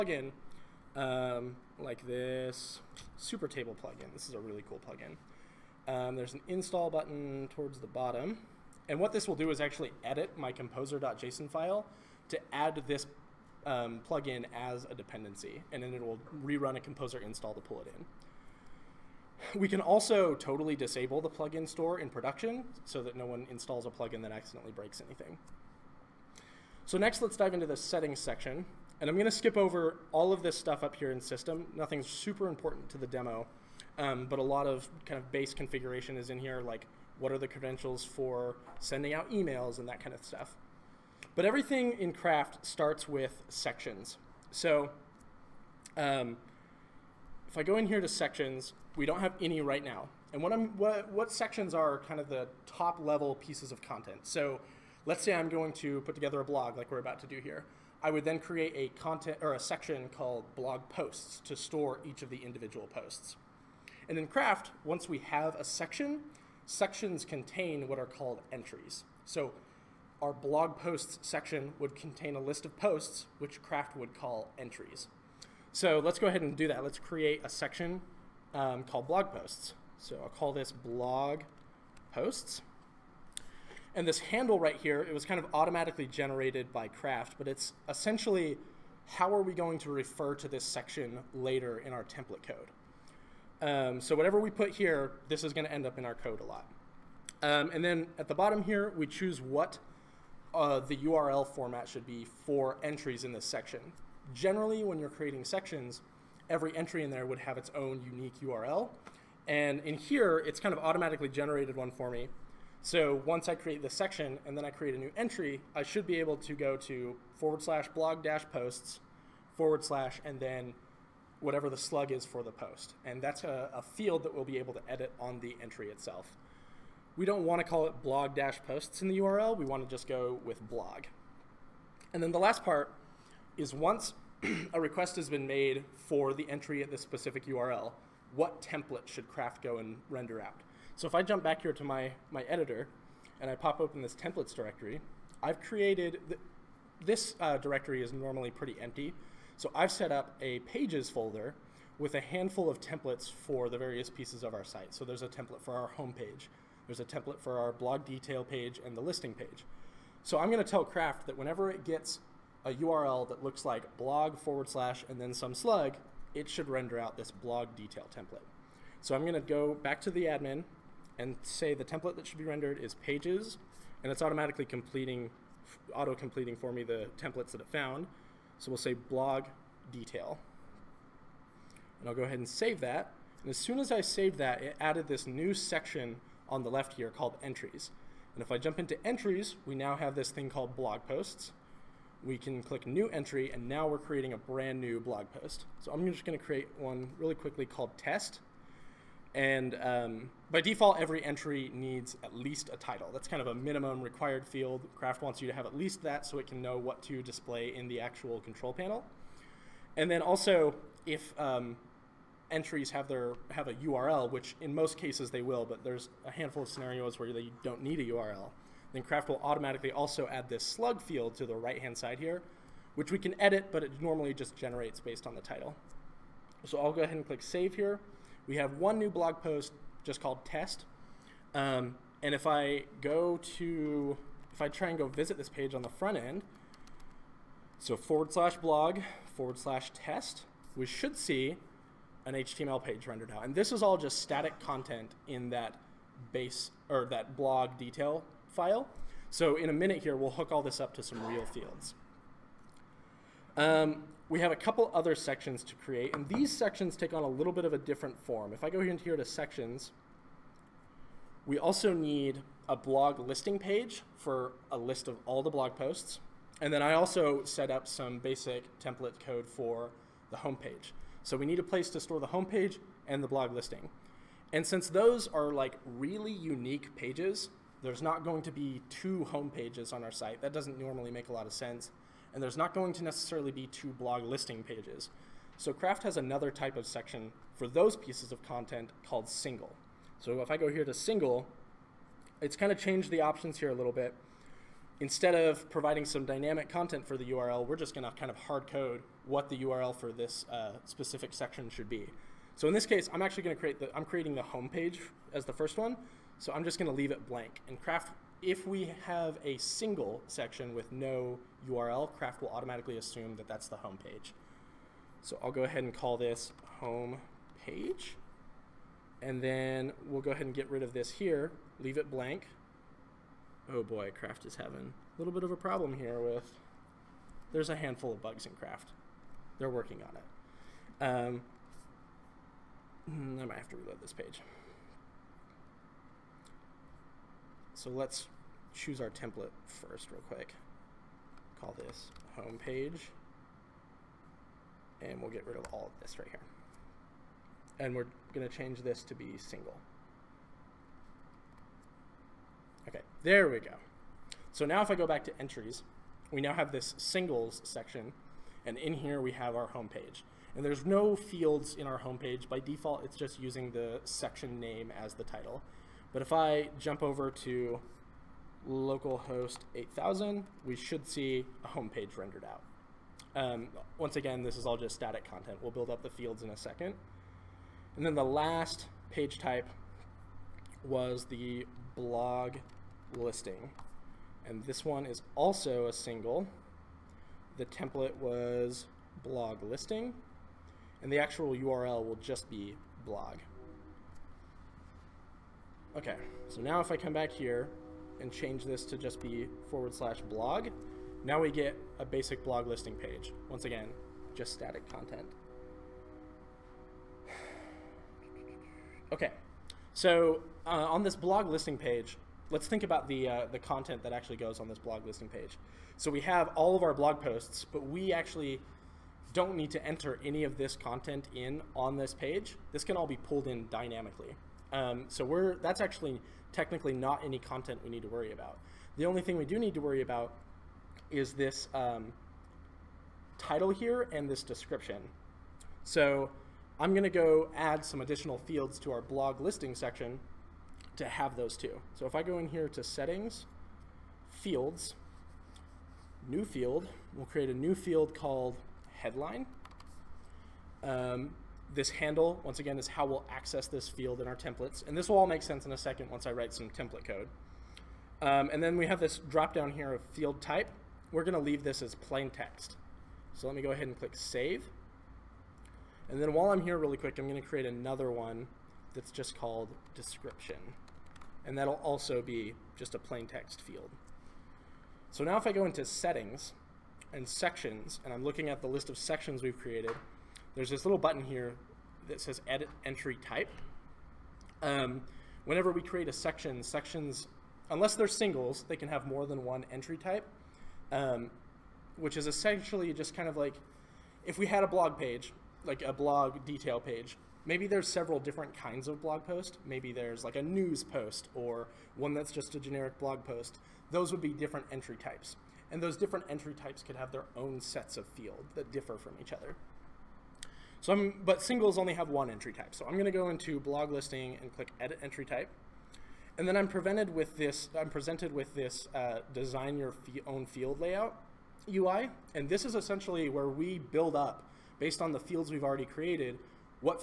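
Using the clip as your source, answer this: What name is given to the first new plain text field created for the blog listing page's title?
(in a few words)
headline.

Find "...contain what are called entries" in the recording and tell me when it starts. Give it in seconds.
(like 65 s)
67 s.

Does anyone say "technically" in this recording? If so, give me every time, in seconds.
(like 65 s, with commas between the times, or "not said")
426 s.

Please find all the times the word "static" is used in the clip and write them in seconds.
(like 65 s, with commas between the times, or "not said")
244 s, 374 s, 404 s.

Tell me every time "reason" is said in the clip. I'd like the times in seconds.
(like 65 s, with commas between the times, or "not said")
not said.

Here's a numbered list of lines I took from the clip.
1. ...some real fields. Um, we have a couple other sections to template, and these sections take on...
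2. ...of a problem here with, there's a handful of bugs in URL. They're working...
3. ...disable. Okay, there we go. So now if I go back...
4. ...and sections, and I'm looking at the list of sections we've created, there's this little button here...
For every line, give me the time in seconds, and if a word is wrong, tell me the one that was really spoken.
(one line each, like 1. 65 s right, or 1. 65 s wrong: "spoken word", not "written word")
1. 251 s wrong: "create", not "template"
2. 325 s wrong: "Craft", not "URL"
3. 349 s wrong: "single", not "disable"
4. 477 s right.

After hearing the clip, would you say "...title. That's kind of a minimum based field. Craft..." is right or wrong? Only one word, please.
wrong.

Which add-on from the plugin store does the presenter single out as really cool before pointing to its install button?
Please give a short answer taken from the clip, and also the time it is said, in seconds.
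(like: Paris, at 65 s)
Super Table, at 3 s.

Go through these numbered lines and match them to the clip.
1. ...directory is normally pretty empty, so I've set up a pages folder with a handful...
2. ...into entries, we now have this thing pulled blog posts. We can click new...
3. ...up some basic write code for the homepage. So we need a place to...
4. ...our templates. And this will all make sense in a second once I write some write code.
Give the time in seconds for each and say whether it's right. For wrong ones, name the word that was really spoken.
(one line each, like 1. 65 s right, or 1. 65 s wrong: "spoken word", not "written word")
1. 147 s right
2. 188 s wrong: "called", not "pulled"
3. 267 s wrong: "template", not "write"
4. 454 s wrong: "template", not "write".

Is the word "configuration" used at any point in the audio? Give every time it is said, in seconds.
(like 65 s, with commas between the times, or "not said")
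35 s.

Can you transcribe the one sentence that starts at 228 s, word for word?
We have one new blog post just called test.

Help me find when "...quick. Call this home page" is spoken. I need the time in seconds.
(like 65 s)
340 s.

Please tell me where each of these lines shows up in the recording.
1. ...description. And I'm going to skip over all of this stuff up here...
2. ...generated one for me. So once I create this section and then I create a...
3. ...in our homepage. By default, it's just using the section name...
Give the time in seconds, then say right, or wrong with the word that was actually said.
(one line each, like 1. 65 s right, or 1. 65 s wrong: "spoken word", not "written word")
1. 28 s wrong: "section", not "description"
2. 111 s right
3. 361 s right.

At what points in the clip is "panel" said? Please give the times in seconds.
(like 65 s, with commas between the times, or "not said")
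208 s.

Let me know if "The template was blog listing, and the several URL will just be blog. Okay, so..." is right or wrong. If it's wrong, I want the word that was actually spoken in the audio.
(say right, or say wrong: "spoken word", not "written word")
wrong: "actual", not "several".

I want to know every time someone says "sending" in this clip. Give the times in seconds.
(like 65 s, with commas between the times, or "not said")
38 s.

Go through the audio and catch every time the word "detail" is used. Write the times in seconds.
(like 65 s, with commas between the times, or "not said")
158 s, 167 s, 179 s, 247 s, 496 s.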